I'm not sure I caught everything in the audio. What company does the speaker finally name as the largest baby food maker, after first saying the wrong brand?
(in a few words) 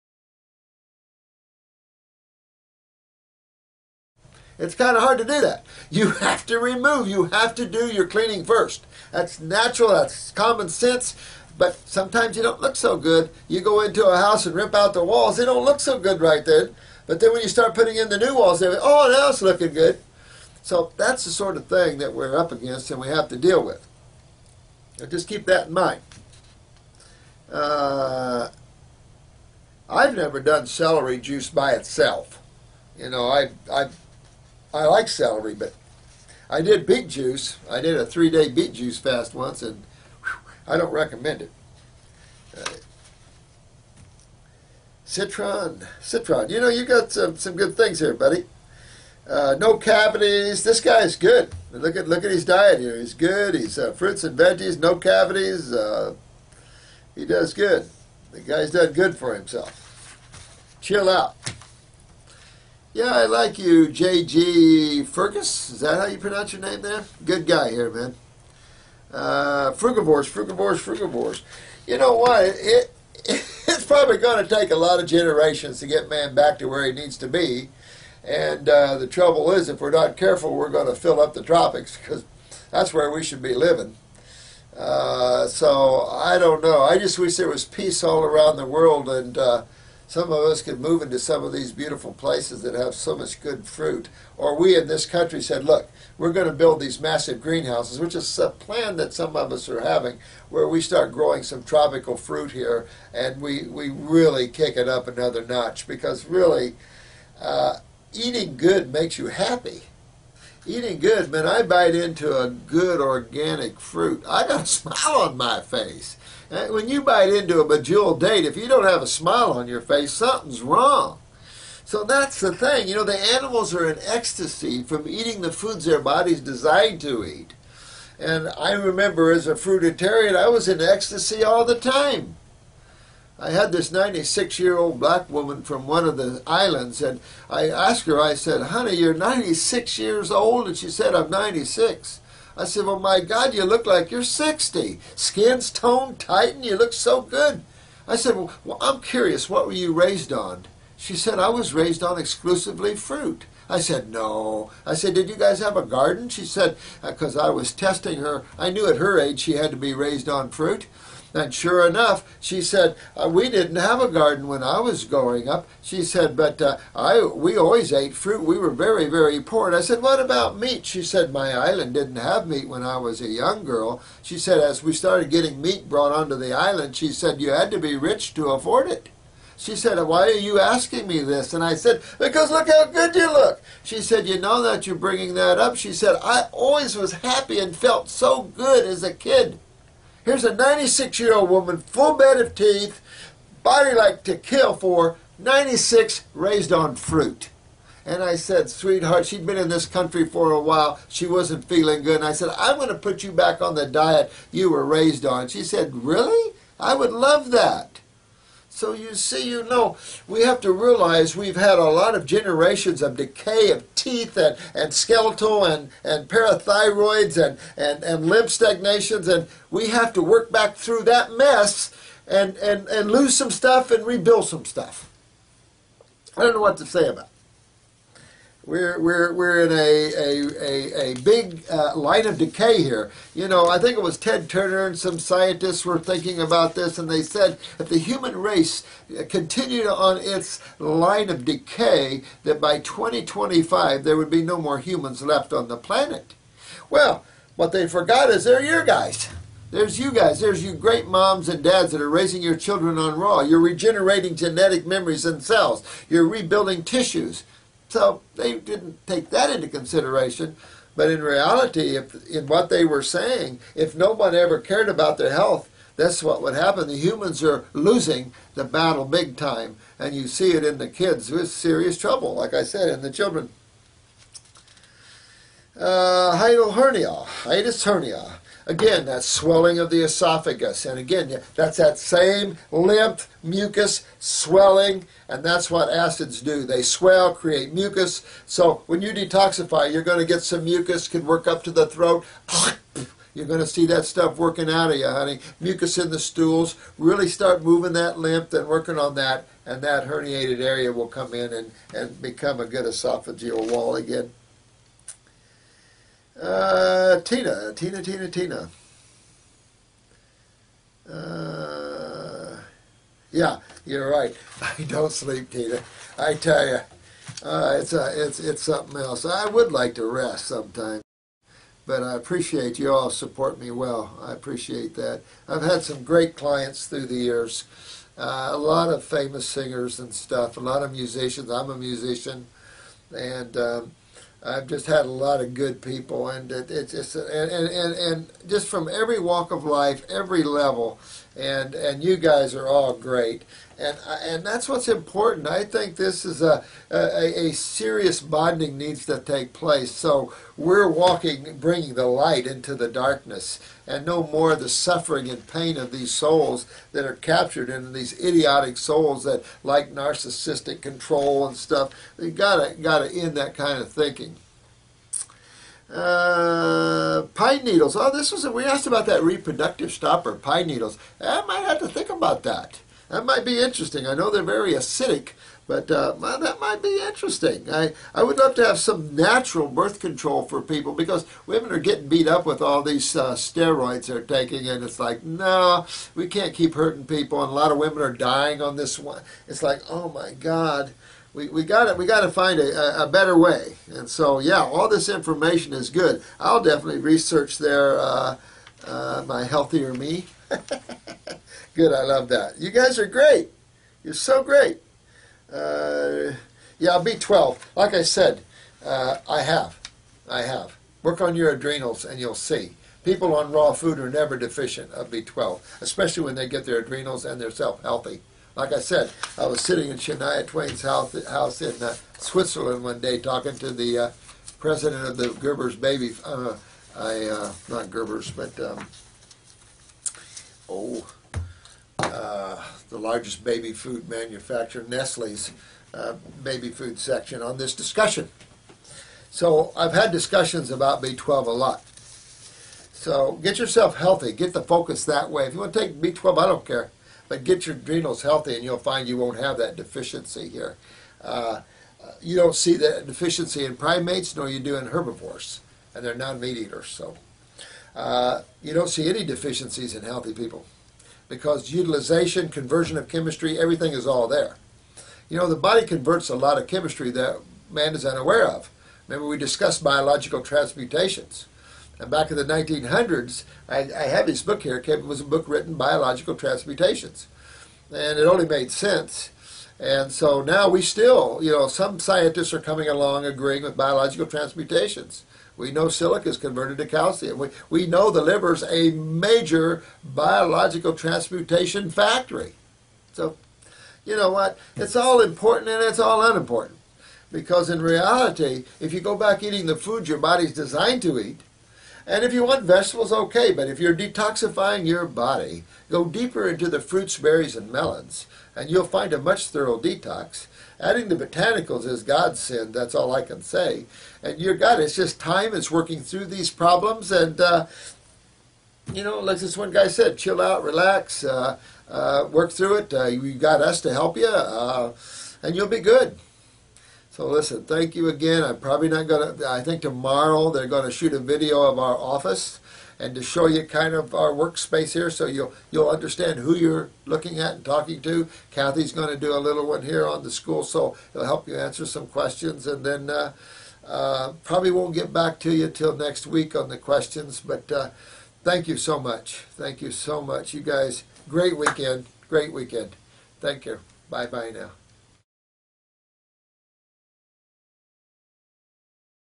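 Nestle.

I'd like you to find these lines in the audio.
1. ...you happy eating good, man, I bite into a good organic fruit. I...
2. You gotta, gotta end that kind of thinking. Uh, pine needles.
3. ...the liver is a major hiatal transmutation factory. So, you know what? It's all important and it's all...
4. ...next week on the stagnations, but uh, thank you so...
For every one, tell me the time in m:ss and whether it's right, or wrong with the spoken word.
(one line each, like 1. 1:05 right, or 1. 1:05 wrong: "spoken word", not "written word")
1. 1:49 right
2. 6:02 right
3. 8:08 wrong: "biological", not "hiatal"
4. 9:05 wrong: "questions", not "stagnations".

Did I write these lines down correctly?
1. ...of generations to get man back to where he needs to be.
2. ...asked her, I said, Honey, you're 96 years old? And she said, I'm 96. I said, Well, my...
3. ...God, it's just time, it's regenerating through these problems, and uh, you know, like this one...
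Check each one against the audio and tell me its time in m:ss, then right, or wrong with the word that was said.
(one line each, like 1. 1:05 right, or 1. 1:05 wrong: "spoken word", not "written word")
1. 1:14 right
2. 2:17 right
3. 8:34 wrong: "working", not "regenerating".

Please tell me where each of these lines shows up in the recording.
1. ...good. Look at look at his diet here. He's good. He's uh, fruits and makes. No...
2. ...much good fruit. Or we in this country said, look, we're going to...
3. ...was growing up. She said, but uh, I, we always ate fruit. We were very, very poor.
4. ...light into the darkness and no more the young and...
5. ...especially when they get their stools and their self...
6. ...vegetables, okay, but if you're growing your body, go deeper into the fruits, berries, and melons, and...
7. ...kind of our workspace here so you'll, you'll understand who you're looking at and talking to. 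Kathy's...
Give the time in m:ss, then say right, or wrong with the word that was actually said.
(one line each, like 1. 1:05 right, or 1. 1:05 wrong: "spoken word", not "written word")
1. 0:51 wrong: "veggies", not "makes"
2. 1:33 right
3. 2:44 right
4. 5:52 wrong: "suffering", not "young"
5. 6:55 wrong: "adrenals", not "stools"
6. 8:22 wrong: "detoxifying", not "growing"
7. 8:53 right.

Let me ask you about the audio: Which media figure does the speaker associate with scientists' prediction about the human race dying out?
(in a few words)
Ted Turner.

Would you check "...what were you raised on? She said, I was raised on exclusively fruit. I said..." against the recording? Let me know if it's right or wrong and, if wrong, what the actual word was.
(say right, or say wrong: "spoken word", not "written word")
right.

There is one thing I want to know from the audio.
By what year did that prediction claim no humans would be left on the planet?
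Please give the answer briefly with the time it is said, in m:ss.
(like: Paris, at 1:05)
2025, at 4:02.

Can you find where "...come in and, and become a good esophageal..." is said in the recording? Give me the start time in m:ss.
5:01.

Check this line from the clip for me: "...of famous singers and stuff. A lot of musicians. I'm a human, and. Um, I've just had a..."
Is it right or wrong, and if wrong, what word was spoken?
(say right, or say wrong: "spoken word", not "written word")
wrong: "musician", not "human".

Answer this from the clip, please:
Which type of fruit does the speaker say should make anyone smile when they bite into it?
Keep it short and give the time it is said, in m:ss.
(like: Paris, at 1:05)
Medjool date, at 1:57.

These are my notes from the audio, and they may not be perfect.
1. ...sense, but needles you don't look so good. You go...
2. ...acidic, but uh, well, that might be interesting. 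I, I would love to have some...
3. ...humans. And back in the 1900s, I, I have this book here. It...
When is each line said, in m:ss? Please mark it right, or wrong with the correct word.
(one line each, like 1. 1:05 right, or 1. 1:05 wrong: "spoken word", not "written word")
1. 0:10 wrong: "sometimes", not "needles"
2. 6:14 right
3. 7:50 wrong: "transmutations", not "humans".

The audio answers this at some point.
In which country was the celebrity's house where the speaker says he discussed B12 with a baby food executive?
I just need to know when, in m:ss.
7:02.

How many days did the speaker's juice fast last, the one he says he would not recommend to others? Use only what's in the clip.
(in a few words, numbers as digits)
3.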